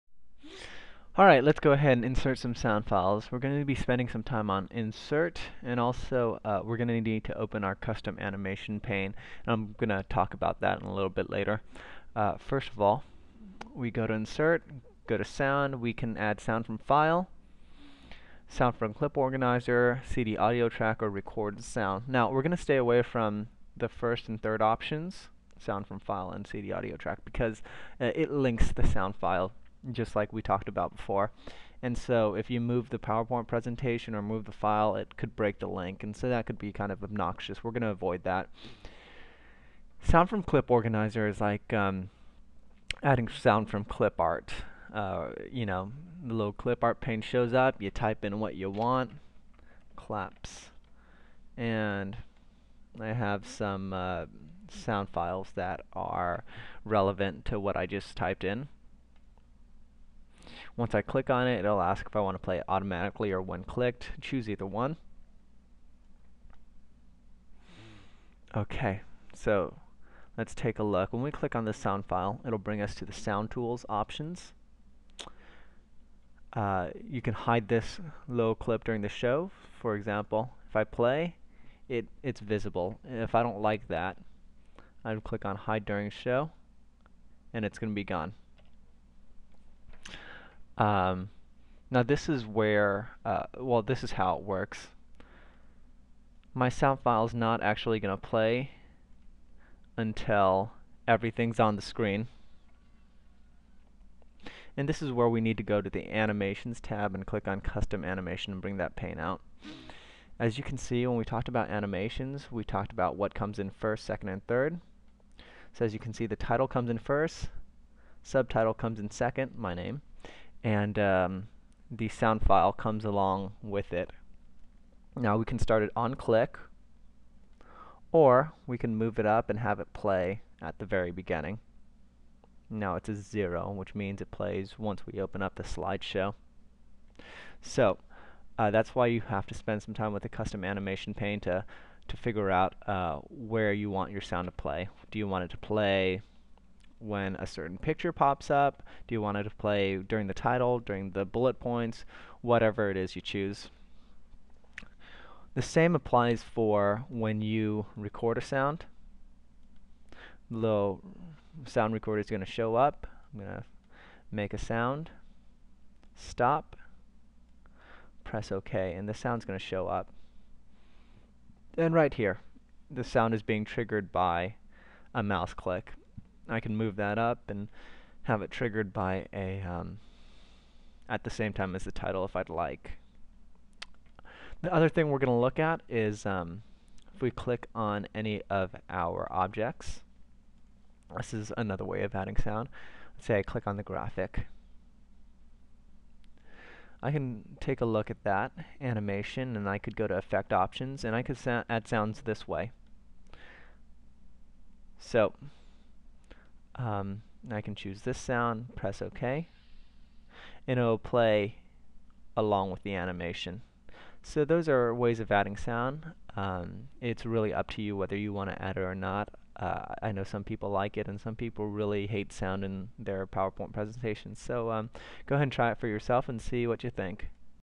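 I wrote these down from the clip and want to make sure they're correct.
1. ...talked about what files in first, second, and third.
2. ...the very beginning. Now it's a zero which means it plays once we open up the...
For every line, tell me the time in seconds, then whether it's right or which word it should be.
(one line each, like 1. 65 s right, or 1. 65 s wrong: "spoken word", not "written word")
1. 112 s wrong: "comes", not "files"
2. 130 s right.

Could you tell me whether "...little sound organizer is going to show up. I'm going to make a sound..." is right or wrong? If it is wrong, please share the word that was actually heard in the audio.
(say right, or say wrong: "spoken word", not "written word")
wrong: "recorder", not "organizer".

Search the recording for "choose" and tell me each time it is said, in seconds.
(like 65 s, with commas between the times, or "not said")
64 s, 153 s, 207 s.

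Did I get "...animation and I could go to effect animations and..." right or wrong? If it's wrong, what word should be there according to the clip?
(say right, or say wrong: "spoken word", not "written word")
wrong: "options", not "animations".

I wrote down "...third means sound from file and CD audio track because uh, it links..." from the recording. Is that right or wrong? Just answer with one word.
wrong.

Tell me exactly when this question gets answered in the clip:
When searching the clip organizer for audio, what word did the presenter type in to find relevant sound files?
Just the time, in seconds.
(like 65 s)
49 s.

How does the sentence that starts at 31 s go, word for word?
And so if you move the PowerPoint presentation or move the file, it could break the link.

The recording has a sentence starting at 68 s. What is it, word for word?
Okay, so let's take a look.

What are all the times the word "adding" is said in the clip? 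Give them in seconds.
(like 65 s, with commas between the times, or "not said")
43 s, 192 s, 215 s.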